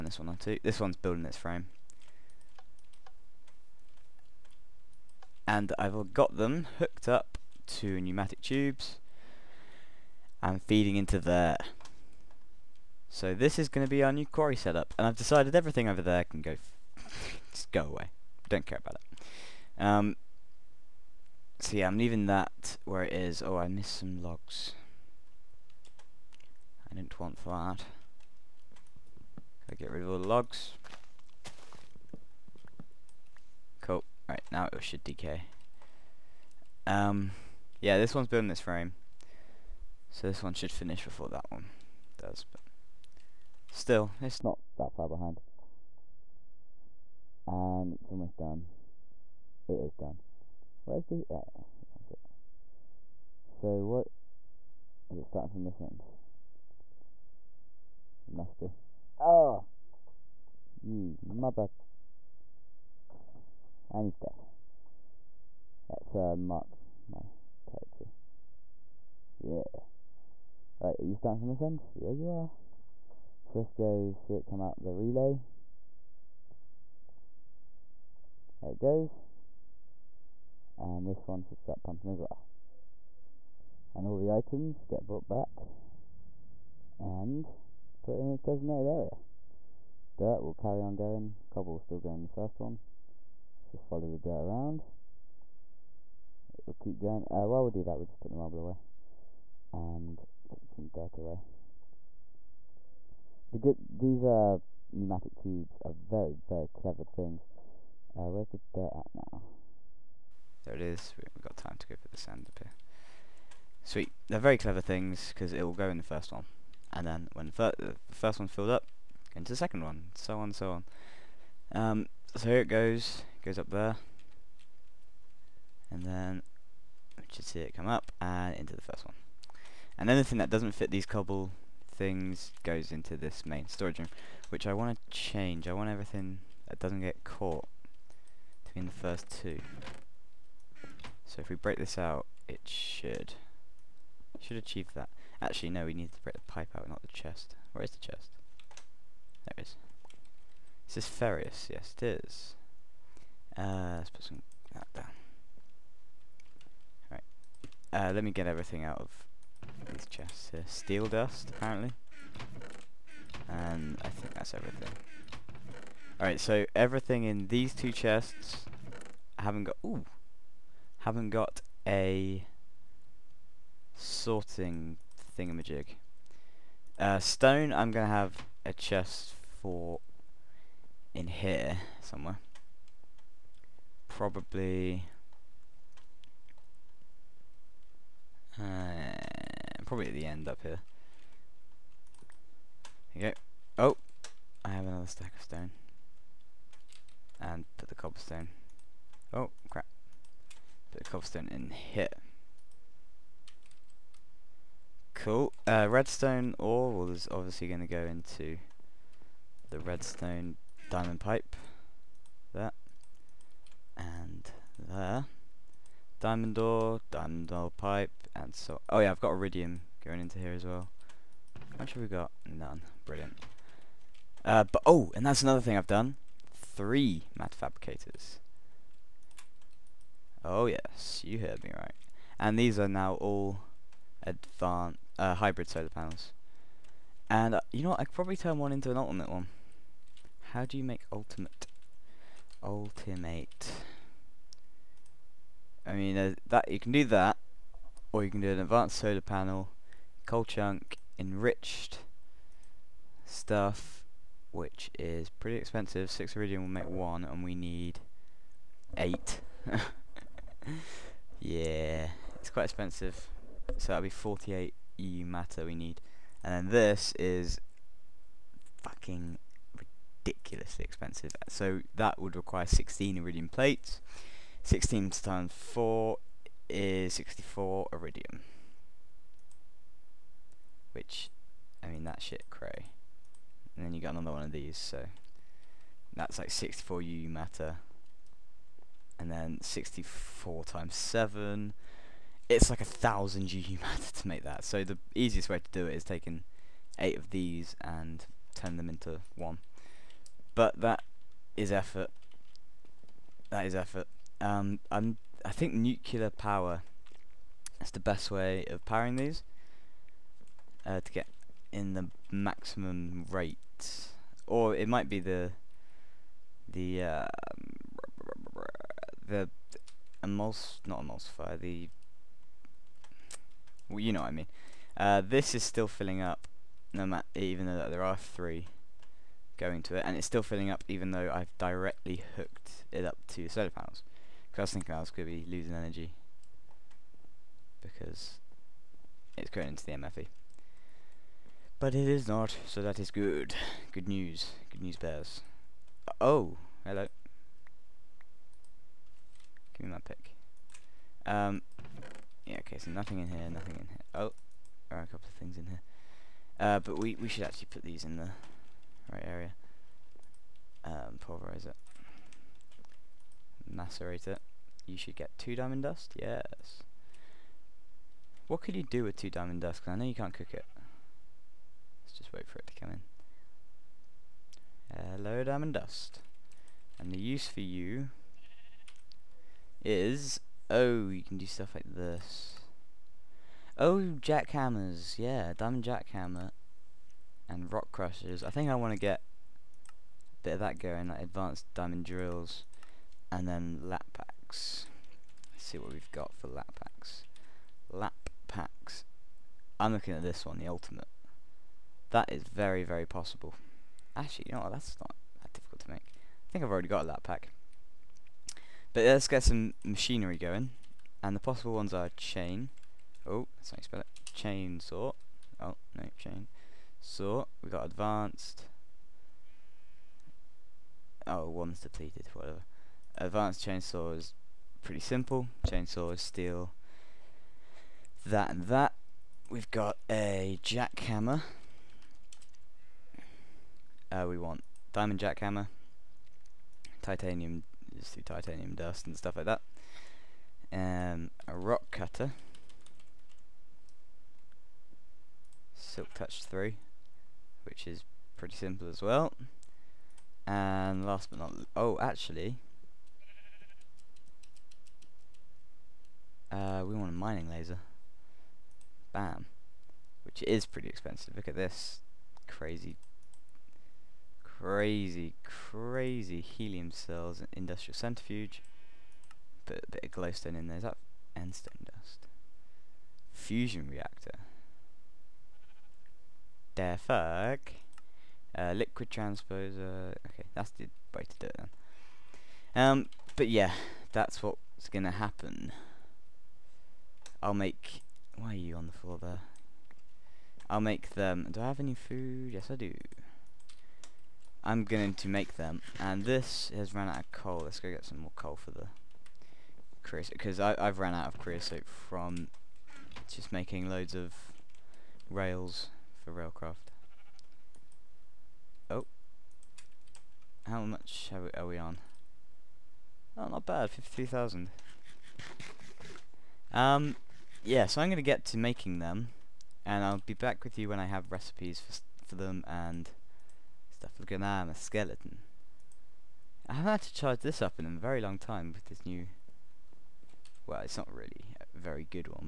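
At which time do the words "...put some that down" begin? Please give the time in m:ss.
2:34.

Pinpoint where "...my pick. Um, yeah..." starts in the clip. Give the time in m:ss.
5:49.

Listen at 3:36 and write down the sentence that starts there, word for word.
Diamond ore, diamond ore pipe, and so...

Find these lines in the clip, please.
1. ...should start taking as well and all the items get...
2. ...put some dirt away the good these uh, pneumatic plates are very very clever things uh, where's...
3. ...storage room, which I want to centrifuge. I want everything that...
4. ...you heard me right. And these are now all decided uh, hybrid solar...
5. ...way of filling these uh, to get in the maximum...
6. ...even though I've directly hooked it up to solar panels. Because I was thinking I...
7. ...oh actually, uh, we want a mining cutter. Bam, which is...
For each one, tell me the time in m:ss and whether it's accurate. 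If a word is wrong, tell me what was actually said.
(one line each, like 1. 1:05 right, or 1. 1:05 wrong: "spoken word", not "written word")
1. 1:21 wrong: "pumping", not "taking"
2. 1:40 wrong: "tubes", not "plates"
3. 2:13 wrong: "change", not "centrifuge"
4. 3:51 wrong: "advanced", not "decided"
5. 5:08 wrong: "powering", not "filling"
6. 5:30 right
7. 7:31 wrong: "laser", not "cutter".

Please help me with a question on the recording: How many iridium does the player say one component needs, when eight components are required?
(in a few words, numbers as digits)
6.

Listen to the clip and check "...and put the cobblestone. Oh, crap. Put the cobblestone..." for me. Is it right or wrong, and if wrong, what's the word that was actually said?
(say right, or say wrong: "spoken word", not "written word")
right.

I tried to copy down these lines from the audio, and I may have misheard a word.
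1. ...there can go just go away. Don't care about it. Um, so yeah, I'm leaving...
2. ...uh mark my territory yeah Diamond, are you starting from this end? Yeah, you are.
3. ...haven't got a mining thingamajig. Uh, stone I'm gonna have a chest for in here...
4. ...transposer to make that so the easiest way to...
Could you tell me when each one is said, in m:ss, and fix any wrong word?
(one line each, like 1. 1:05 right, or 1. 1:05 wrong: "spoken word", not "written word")
1. 0:16 right
2. 1:06 wrong: "Right", not "Diamond"
3. 2:50 wrong: "sorting", not "mining"
4. 4:53 wrong: "matter", not "transposer".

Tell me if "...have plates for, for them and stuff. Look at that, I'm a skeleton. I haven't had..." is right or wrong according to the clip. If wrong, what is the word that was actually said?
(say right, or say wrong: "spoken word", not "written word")
wrong: "recipes", not "plates".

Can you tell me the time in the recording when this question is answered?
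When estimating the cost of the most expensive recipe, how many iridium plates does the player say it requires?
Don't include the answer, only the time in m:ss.
4:32.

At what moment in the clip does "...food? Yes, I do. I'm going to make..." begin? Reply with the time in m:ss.
8:11.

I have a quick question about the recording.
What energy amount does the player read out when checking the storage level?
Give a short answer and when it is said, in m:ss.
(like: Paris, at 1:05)
53,000, at 8:33.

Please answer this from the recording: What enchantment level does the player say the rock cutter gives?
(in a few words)
Silk Touch 3.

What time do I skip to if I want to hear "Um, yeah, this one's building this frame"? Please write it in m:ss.
0:36.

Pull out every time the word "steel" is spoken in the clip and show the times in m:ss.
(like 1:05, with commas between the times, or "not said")
2:40, 7:06.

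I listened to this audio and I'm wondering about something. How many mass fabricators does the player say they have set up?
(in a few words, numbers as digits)
3.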